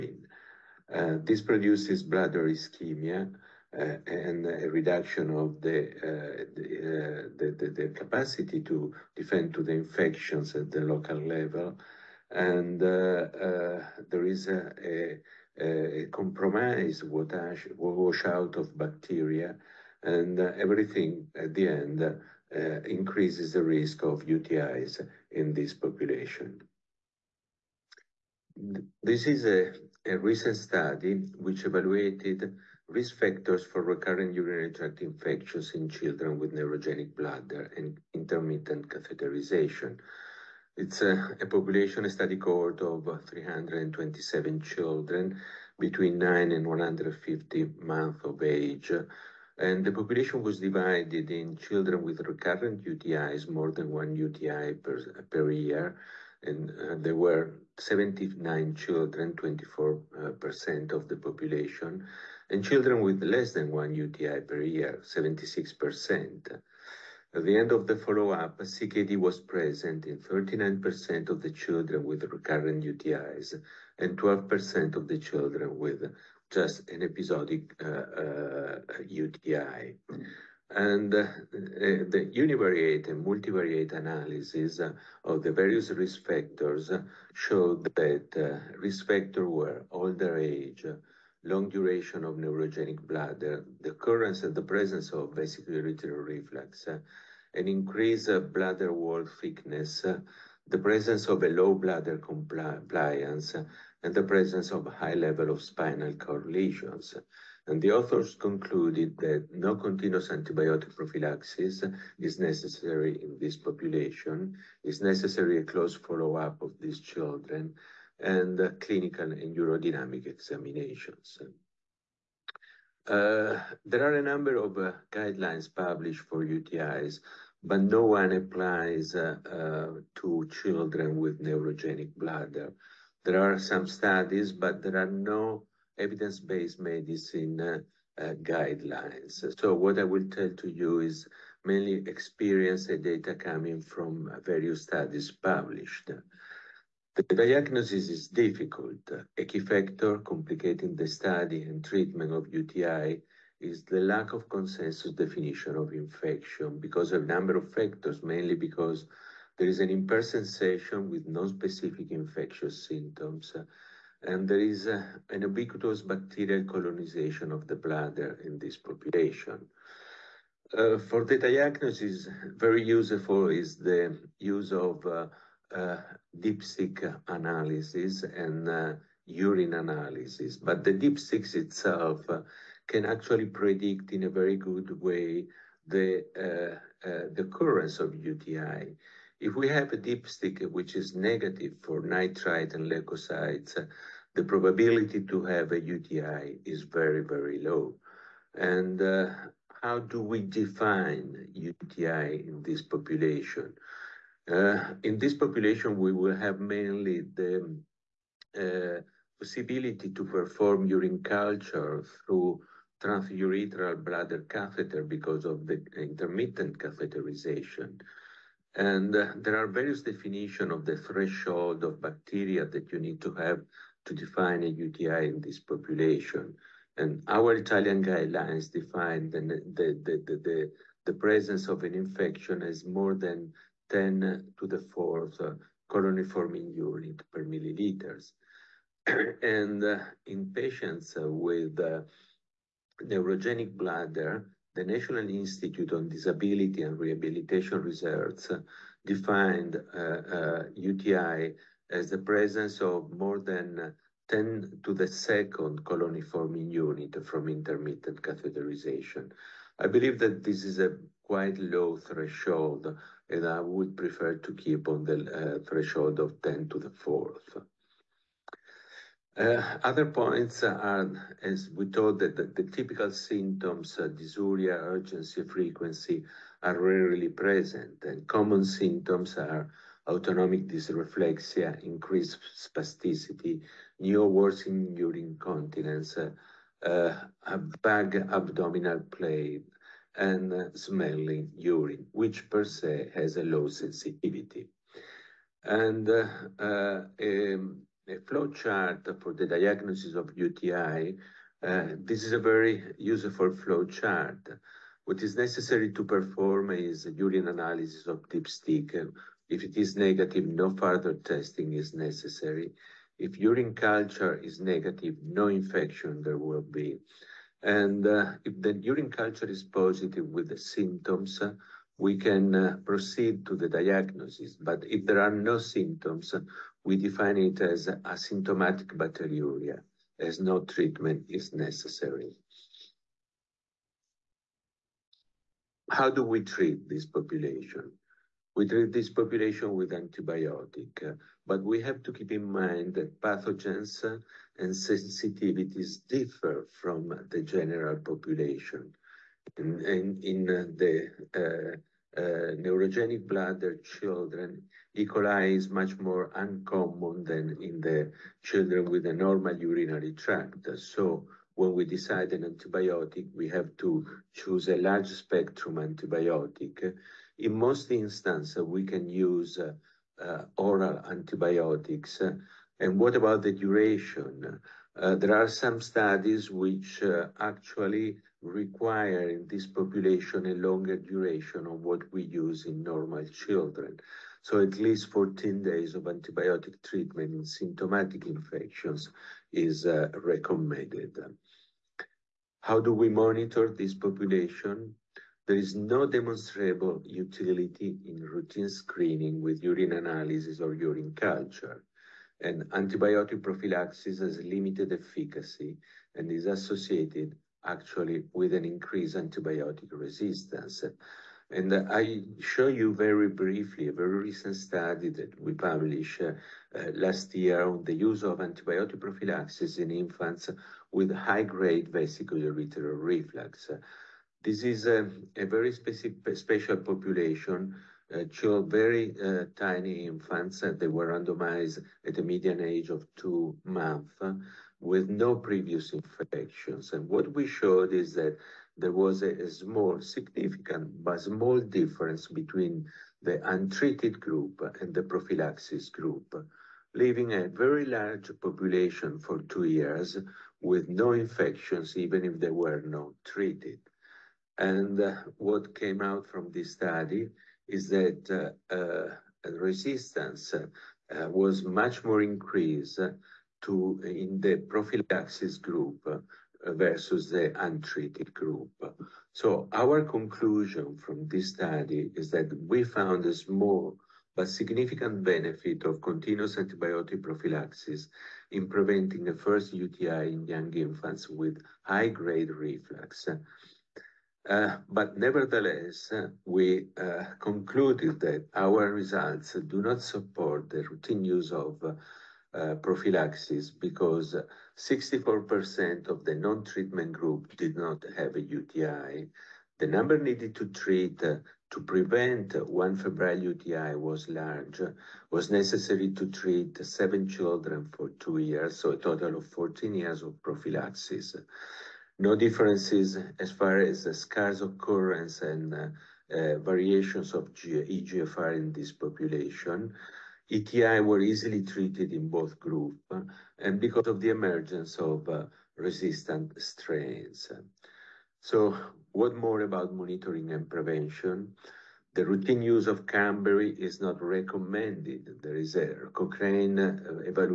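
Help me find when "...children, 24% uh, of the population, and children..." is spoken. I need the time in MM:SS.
00:58.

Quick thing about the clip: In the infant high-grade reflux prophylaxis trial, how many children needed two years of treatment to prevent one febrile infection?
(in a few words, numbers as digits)
7.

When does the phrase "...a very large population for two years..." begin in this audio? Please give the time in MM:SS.
07:27.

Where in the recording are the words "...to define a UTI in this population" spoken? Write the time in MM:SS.
03:44.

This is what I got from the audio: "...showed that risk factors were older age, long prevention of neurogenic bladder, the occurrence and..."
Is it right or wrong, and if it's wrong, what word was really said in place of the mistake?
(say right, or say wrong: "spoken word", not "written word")
wrong: "duration", not "prevention".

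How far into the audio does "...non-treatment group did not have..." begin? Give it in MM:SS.
08:16.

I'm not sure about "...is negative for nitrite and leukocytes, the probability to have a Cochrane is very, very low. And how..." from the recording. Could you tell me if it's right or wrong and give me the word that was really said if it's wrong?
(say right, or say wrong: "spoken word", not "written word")
wrong: "UTI", not "Cochrane".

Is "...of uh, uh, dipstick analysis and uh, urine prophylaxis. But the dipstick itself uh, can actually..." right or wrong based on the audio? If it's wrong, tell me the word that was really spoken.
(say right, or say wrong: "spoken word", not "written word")
wrong: "analysis", not "prophylaxis".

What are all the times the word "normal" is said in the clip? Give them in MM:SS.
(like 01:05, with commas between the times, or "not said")
05:59, 06:22.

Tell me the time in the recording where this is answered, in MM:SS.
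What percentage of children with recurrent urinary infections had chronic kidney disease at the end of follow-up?
01:10.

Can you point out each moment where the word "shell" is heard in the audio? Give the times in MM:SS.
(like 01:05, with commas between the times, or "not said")
not said.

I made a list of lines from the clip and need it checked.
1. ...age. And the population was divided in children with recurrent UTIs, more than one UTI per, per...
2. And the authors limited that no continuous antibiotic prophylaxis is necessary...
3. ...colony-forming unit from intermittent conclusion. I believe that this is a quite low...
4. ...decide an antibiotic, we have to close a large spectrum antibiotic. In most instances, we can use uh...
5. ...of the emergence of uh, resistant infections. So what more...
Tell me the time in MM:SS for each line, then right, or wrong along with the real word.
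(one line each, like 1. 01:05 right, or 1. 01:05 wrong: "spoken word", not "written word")
1. 00:48 right
2. 01:47 wrong: "concluded", not "limited"
3. 04:15 wrong: "catheterization", not "conclusion"
4. 06:01 wrong: "choose", not "close"
5. 08:44 wrong: "strains", not "infections".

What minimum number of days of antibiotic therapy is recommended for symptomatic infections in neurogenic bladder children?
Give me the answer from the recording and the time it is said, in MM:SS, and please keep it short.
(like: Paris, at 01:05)
14 days, at 06:25.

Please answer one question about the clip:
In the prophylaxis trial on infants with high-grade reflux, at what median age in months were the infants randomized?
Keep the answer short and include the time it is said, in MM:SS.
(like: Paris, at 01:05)
2 months, at 07:13.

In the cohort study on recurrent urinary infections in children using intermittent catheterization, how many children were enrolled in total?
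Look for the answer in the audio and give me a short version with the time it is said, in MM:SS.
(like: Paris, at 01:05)
327, at 00:43.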